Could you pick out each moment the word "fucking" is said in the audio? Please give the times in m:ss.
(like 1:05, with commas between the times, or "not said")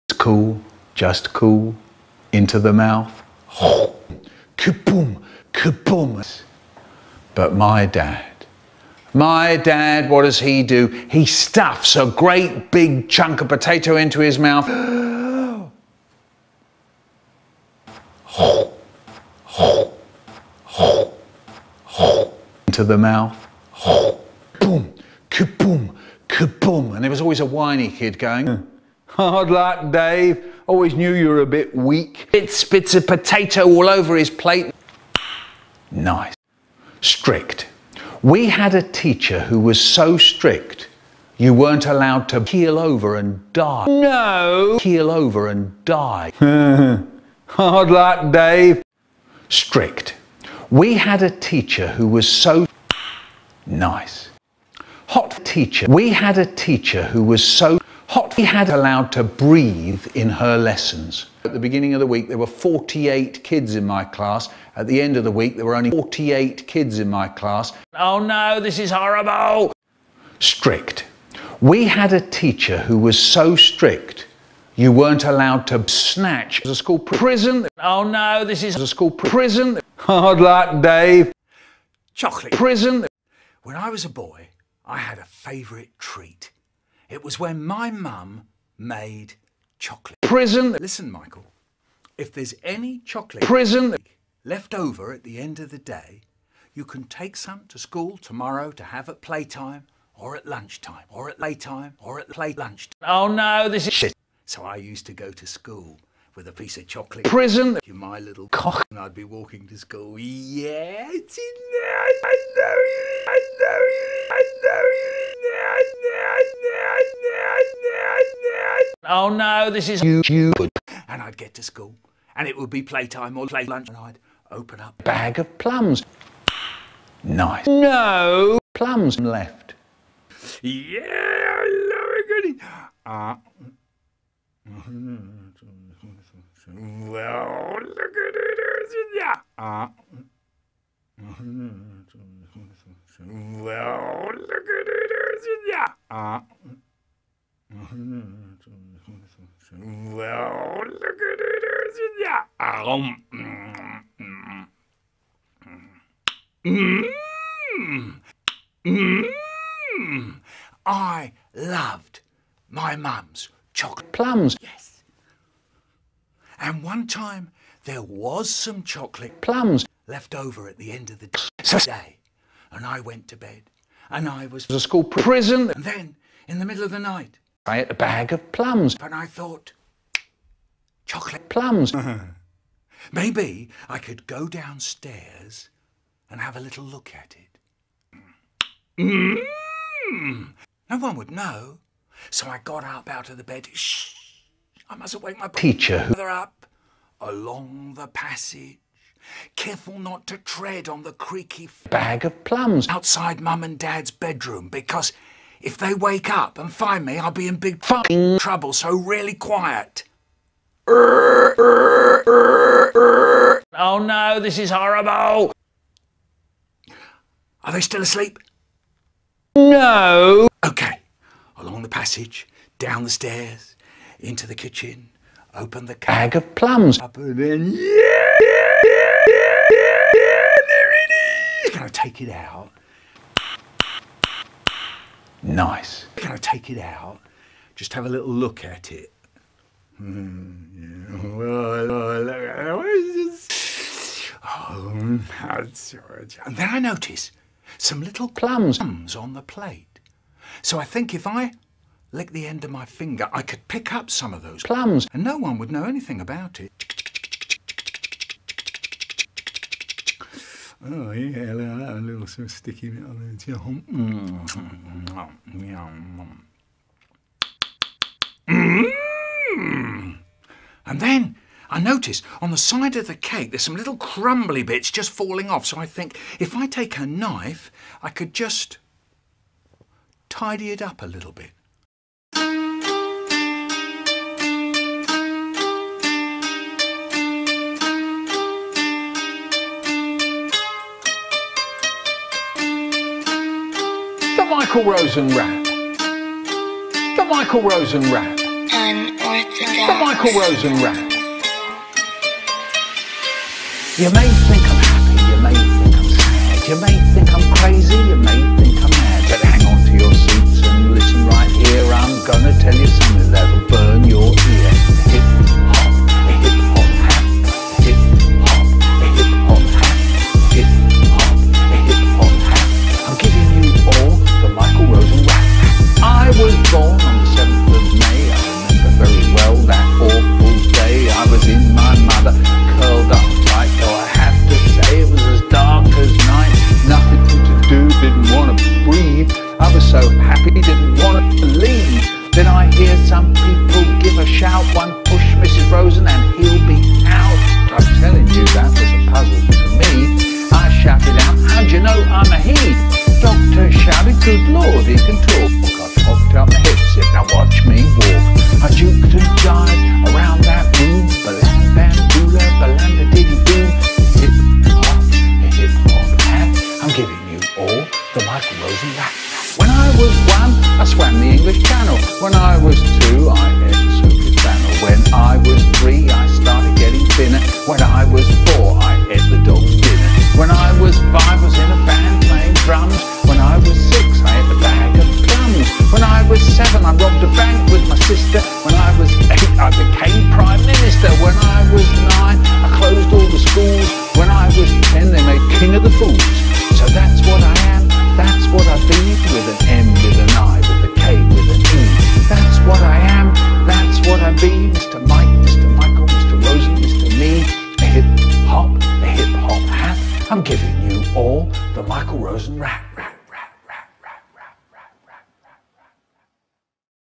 3:27.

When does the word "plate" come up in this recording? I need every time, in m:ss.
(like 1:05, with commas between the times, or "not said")
0:34, 4:09.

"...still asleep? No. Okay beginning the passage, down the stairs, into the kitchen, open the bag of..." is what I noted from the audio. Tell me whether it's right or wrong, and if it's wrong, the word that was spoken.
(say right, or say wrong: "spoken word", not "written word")
wrong: "along", not "beginning".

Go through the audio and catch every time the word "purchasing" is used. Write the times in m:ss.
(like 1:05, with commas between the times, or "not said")
not said.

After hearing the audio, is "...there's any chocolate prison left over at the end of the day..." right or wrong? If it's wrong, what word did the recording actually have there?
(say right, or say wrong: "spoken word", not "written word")
right.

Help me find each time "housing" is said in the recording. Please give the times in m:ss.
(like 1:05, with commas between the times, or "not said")
not said.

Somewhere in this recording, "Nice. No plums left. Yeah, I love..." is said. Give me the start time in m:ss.
2:07.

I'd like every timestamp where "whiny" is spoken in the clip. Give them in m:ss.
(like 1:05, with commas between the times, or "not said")
0:27.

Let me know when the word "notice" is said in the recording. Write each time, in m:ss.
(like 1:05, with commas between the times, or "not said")
4:06, 4:31.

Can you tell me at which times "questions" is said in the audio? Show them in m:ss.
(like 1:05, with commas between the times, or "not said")
not said.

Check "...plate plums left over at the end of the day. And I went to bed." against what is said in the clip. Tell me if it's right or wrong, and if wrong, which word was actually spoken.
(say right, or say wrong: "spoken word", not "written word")
wrong: "chocolate", not "plate".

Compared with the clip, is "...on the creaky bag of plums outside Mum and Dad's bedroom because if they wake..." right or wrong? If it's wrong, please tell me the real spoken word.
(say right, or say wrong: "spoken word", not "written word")
right.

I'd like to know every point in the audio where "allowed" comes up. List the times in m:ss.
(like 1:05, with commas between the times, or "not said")
0:41, 0:58, 1:15.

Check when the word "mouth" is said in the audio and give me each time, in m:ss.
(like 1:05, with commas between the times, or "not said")
0:02, 0:14, 0:22.